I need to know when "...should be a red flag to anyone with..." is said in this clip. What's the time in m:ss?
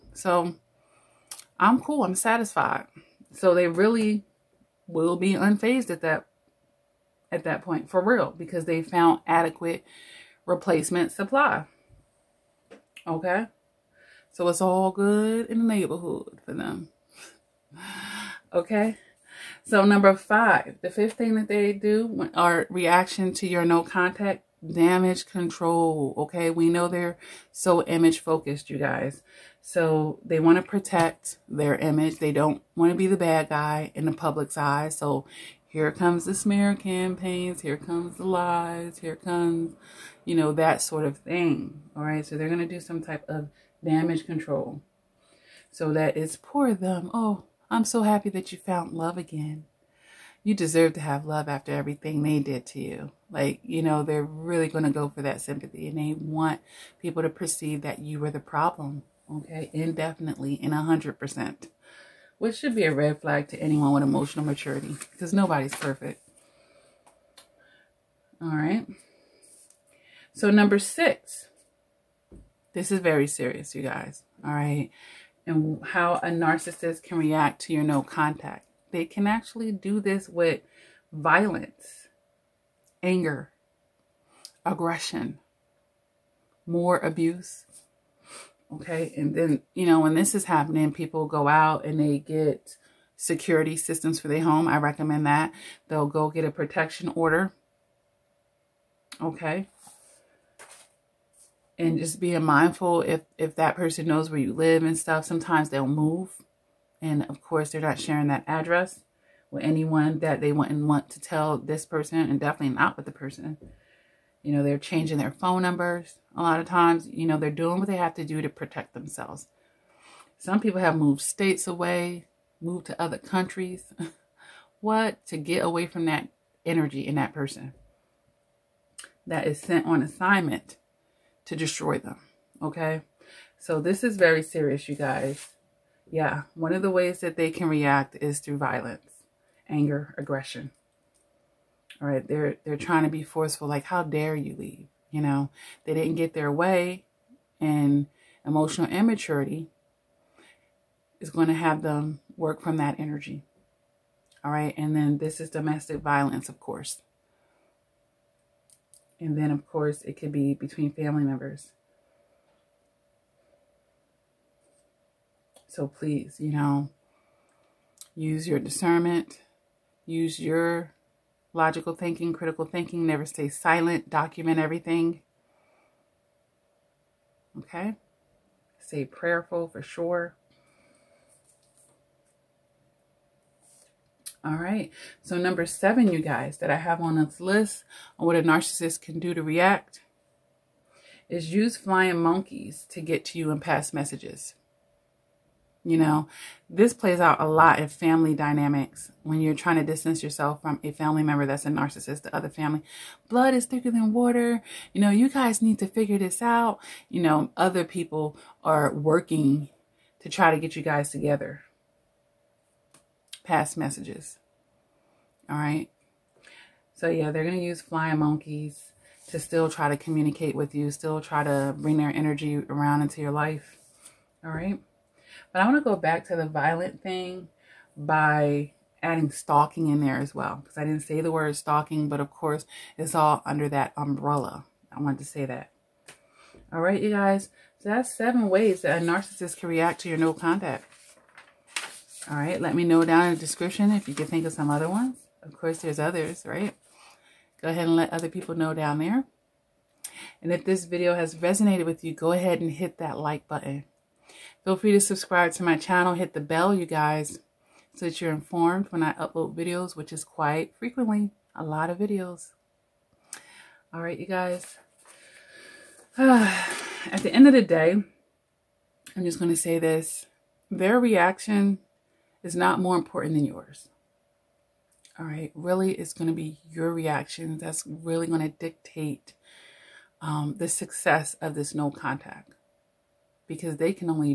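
1:02.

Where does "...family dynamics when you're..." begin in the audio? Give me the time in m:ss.
3:17.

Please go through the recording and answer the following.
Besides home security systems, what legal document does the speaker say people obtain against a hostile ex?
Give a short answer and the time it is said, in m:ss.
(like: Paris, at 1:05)
Protection order, at 1:36.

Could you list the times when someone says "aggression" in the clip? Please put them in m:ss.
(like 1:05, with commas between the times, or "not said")
1:24, 2:20.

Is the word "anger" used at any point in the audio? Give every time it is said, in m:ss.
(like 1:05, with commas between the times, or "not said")
1:23, 2:19.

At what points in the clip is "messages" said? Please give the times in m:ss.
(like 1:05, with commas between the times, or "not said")
3:13, 3:33.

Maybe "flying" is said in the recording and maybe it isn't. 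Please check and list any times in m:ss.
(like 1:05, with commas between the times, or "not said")
3:11, 3:37.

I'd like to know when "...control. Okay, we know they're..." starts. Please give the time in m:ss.
0:25.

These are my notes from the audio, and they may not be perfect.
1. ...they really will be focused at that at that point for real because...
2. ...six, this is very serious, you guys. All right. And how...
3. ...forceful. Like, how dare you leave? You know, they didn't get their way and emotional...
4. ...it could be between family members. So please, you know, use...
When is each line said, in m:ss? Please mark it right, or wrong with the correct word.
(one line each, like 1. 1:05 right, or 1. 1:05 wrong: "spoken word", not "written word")
1. 0:03 wrong: "unfazed", not "focused"
2. 1:10 right
3. 2:23 right
4. 2:40 right.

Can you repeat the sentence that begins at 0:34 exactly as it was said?
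So here comes the smear campaigns.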